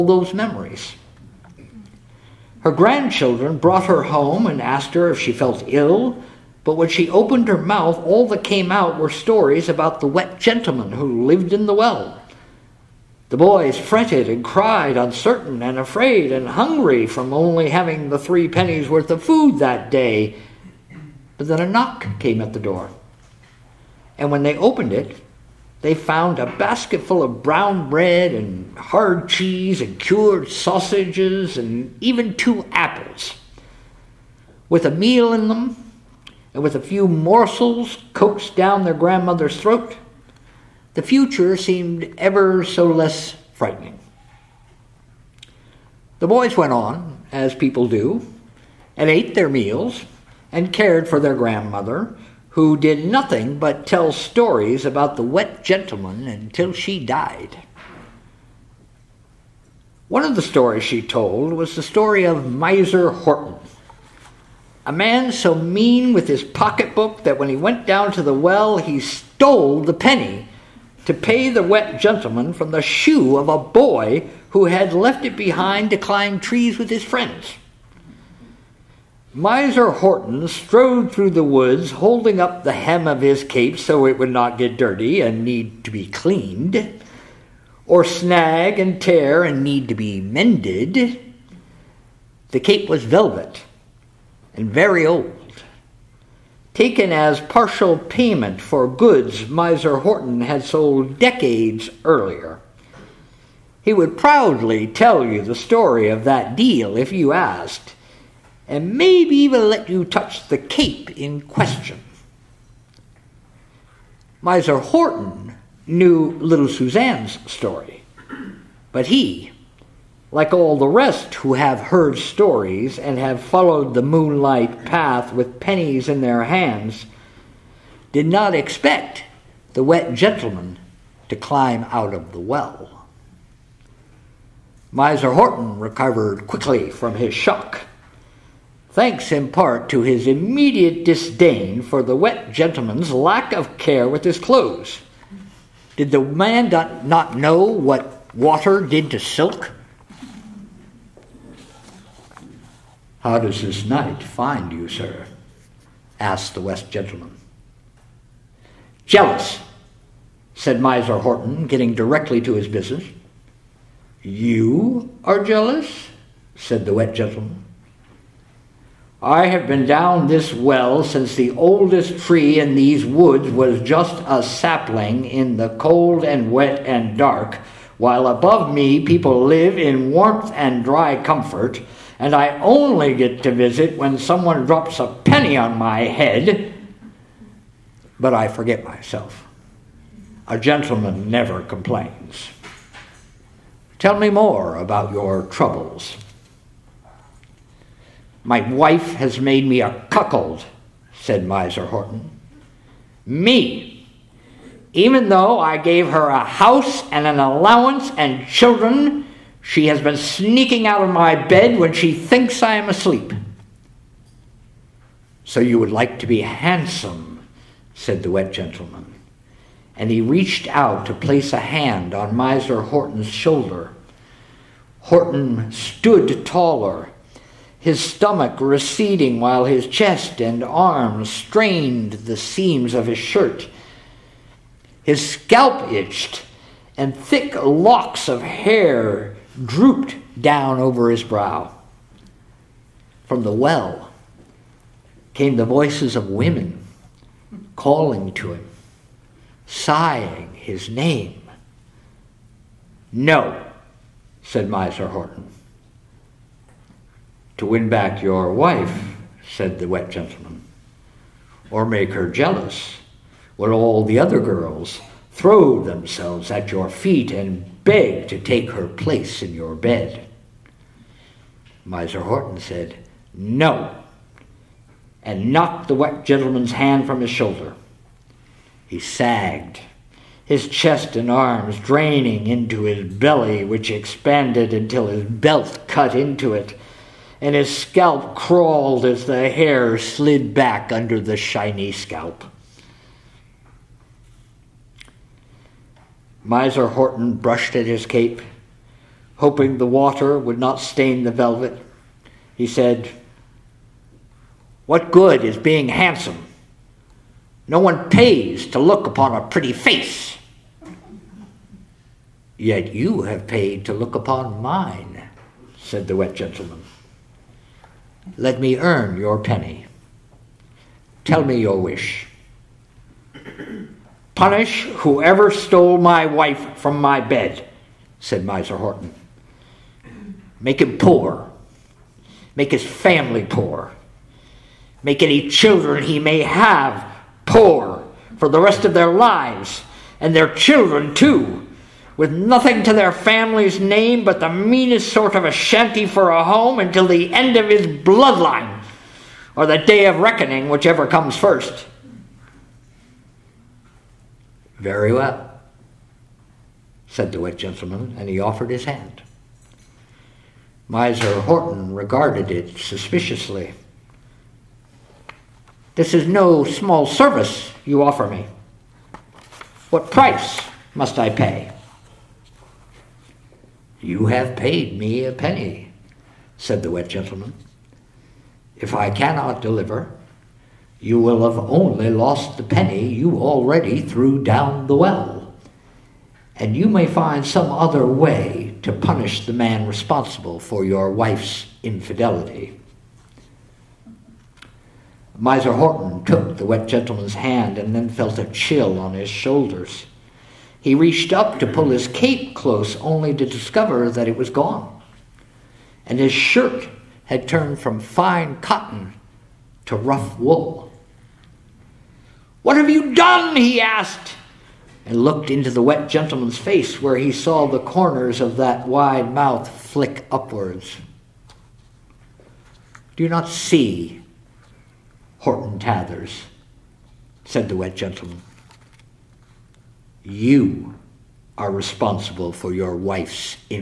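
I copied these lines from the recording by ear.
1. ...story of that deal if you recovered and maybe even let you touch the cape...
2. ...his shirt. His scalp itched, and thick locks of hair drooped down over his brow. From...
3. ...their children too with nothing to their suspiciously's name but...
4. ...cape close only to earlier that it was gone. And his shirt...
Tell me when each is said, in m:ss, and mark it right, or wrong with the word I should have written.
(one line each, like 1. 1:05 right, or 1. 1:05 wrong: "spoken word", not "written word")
1. 1:45 wrong: "asked", not "recovered"
2. 3:53 right
3. 5:40 wrong: "family", not "suspiciously"
4. 6:42 wrong: "discover", not "earlier".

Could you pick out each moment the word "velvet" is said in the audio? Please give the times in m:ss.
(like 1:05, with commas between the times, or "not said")
1:33, 5:01.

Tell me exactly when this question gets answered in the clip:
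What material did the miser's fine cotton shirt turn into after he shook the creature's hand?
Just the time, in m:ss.
6:49.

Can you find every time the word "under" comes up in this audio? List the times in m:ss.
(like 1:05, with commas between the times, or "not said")
4:50.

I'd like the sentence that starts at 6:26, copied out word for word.
And you may find some other way to punish the man responsible for your wife's infidelity.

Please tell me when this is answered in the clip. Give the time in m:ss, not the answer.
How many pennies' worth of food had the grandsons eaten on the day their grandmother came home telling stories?
0:18.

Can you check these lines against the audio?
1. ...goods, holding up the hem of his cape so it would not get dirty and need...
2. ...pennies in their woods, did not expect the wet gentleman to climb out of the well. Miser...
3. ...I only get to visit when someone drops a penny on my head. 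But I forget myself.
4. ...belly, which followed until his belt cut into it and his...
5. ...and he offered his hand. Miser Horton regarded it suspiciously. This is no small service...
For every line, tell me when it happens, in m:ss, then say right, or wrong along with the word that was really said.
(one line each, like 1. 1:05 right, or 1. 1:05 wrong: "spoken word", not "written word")
1. 1:21 wrong: "woods", not "goods"
2. 2:05 wrong: "hands", not "woods"
3. 3:02 right
4. 4:43 wrong: "expanded", not "followed"
5. 5:58 right.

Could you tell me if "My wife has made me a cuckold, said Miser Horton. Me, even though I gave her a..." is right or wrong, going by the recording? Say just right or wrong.
right.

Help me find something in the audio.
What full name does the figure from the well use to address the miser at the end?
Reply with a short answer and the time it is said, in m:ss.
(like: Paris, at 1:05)
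Horton Tathers, at 7:05.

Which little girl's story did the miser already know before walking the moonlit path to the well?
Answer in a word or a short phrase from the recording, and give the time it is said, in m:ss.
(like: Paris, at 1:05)
Suzanne, at 1:56.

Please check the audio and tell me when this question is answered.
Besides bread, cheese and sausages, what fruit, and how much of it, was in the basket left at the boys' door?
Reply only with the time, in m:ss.
0:32.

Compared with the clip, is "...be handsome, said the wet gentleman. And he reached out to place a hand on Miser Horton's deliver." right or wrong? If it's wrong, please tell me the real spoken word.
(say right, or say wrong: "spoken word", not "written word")
wrong: "shoulder", not "deliver".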